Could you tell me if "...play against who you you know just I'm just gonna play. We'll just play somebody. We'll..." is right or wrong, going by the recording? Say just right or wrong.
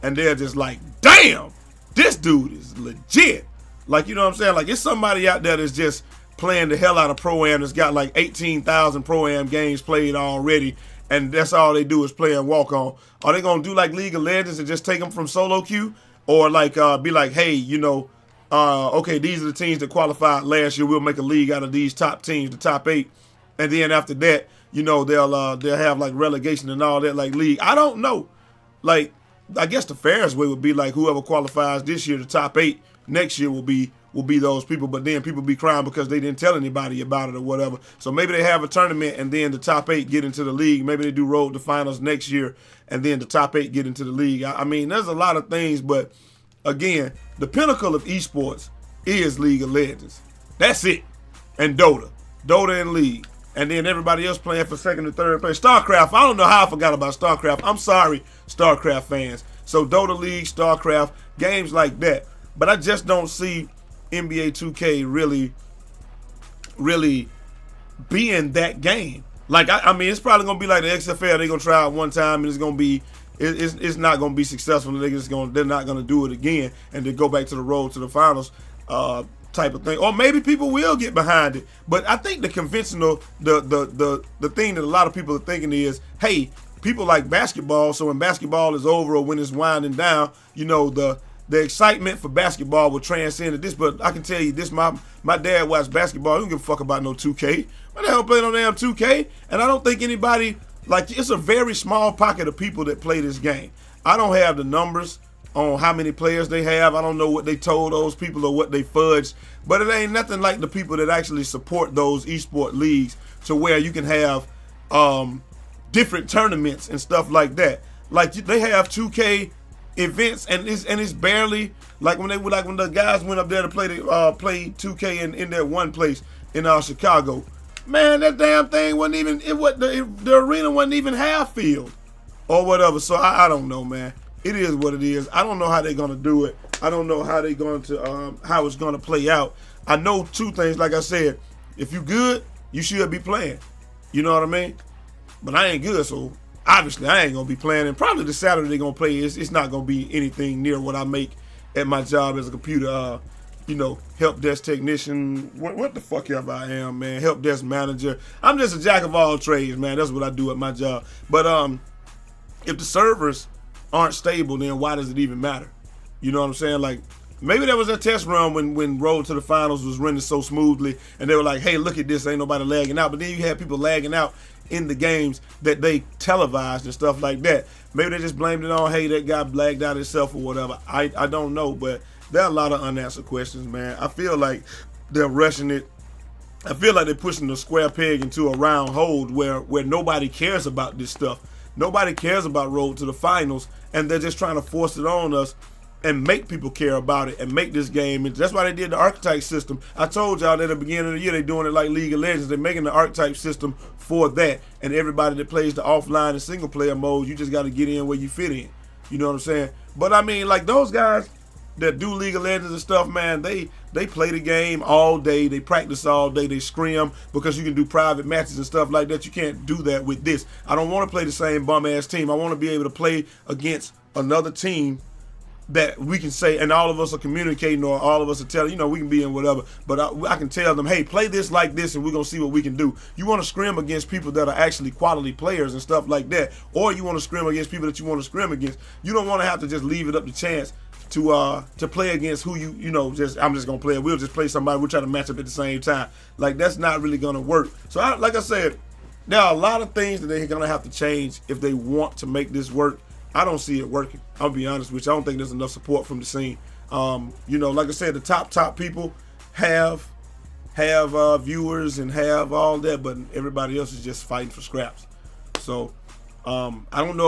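right.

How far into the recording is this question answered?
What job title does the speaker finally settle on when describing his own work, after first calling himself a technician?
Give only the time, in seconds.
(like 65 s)
157 s.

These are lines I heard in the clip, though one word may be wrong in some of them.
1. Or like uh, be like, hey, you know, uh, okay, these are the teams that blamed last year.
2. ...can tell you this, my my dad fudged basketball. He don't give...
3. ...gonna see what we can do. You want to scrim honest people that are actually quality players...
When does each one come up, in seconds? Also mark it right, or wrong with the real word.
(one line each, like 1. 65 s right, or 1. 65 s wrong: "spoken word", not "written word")
1. 16 s wrong: "qualified", not "blamed"
2. 94 s wrong: "watched", not "fudged"
3. 232 s wrong: "against", not "honest".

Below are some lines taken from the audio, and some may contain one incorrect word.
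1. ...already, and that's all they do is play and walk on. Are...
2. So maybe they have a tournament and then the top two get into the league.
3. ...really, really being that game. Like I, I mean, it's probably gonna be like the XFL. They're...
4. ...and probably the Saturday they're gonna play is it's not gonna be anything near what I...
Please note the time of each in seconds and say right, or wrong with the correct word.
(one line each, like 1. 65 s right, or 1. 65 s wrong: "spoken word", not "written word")
1. 10 s right
2. 37 s wrong: "eight", not "two"
3. 65 s right
4. 147 s right.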